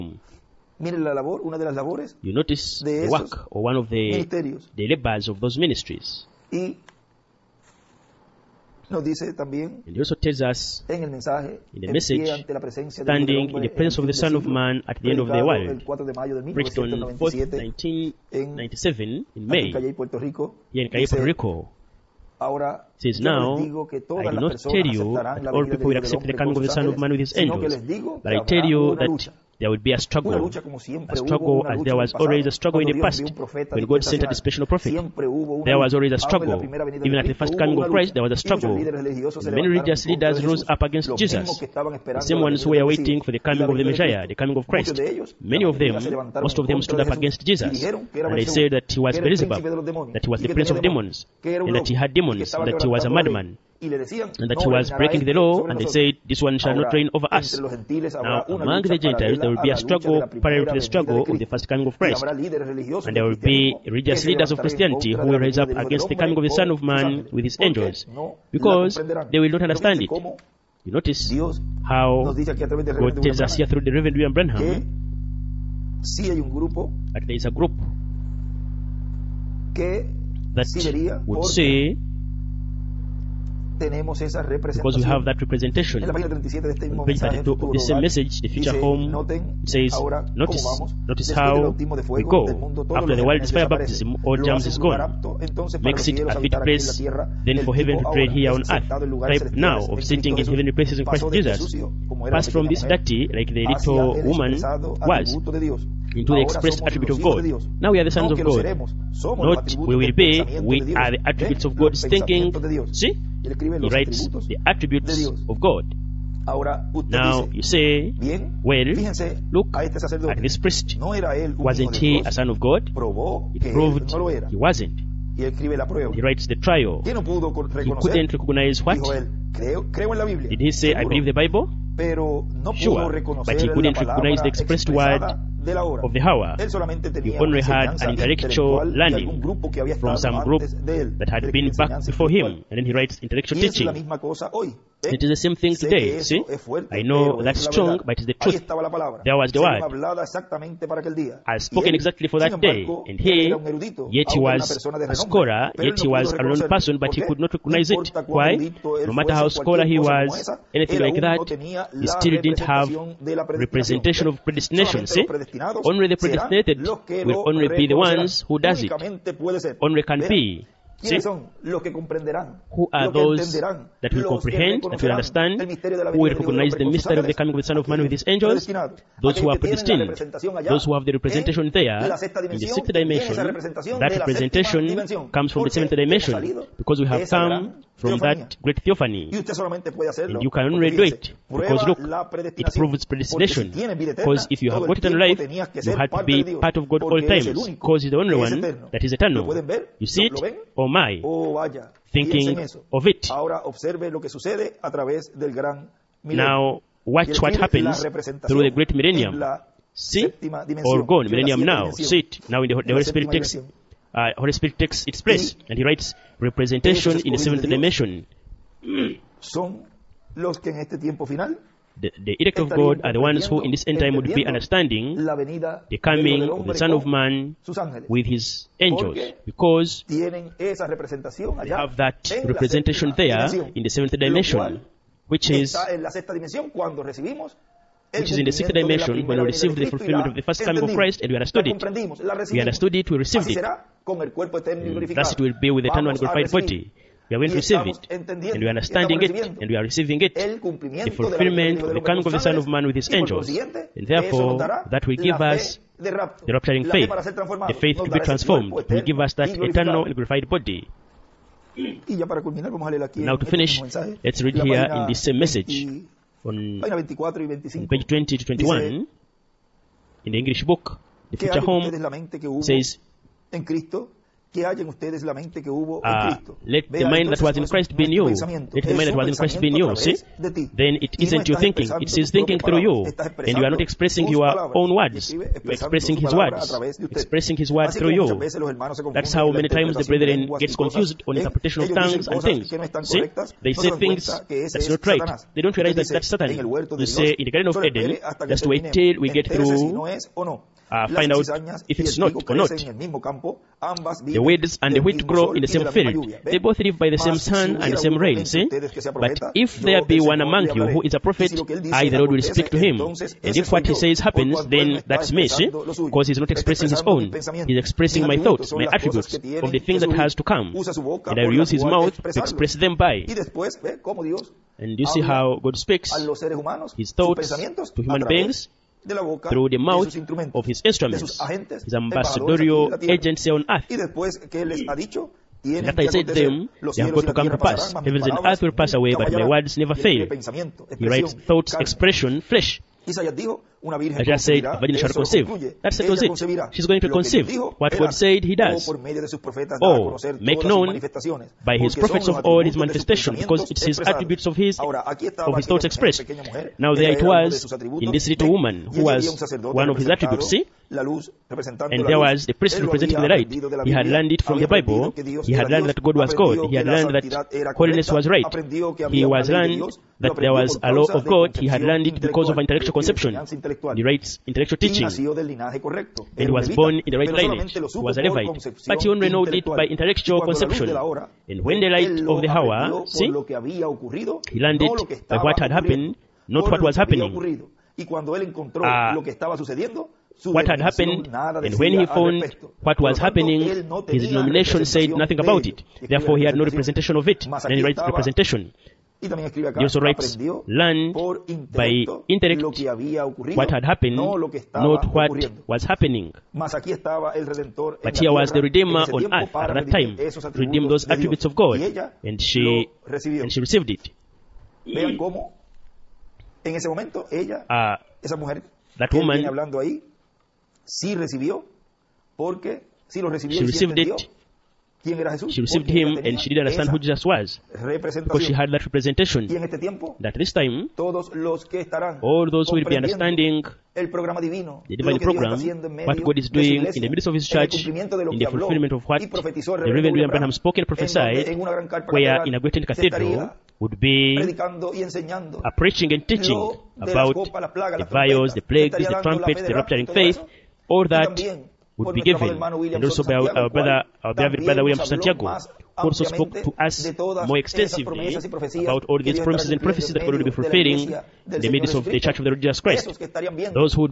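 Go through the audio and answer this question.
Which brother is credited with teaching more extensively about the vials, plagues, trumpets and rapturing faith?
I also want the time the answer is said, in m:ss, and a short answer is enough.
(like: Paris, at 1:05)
William Santiago, at 7:34.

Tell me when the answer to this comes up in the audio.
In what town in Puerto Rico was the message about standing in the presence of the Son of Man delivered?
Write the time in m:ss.
0:20.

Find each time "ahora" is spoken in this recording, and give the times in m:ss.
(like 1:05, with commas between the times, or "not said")
0:22, 1:29, 3:23.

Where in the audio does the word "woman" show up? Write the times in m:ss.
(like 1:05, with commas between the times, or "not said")
1:44, 5:58, 6:59.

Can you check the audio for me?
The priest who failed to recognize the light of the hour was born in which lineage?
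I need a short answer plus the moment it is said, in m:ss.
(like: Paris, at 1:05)
Levite, at 6:18.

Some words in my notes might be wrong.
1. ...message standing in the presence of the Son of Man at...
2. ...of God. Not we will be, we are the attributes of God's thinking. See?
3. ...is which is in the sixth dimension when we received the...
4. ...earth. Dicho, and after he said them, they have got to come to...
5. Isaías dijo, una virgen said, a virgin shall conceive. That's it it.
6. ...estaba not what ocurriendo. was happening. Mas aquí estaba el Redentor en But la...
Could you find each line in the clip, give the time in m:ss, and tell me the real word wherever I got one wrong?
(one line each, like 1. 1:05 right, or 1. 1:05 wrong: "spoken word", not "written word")
1. 0:11 right
2. 1:48 right
3. 3:55 right
4. 5:33 right
5. 5:43 right
6. 6:44 right.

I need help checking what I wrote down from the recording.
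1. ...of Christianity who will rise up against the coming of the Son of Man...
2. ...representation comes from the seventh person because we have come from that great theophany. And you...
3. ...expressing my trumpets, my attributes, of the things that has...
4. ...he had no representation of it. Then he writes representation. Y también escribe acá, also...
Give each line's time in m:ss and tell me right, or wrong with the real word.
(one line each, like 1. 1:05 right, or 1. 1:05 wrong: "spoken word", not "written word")
1. 1:04 right
2. 3:04 wrong: "dimension", not "person"
3. 5:17 wrong: "thoughts", not "trumpets"
4. 6:36 right.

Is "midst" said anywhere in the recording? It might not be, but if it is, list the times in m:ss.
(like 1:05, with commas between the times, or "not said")
7:17, 7:41.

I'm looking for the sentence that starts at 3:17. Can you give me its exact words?
Because He's the only one that is eternal.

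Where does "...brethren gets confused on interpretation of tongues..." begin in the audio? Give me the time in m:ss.
4:50.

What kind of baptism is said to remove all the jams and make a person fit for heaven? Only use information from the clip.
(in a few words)
fire baptism.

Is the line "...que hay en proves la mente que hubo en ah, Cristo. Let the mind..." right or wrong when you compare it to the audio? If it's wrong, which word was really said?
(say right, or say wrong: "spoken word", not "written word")
wrong: "ustedes", not "proves".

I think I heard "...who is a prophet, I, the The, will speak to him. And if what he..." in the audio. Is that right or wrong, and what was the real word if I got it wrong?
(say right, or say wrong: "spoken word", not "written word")
wrong: "Lord", not "The".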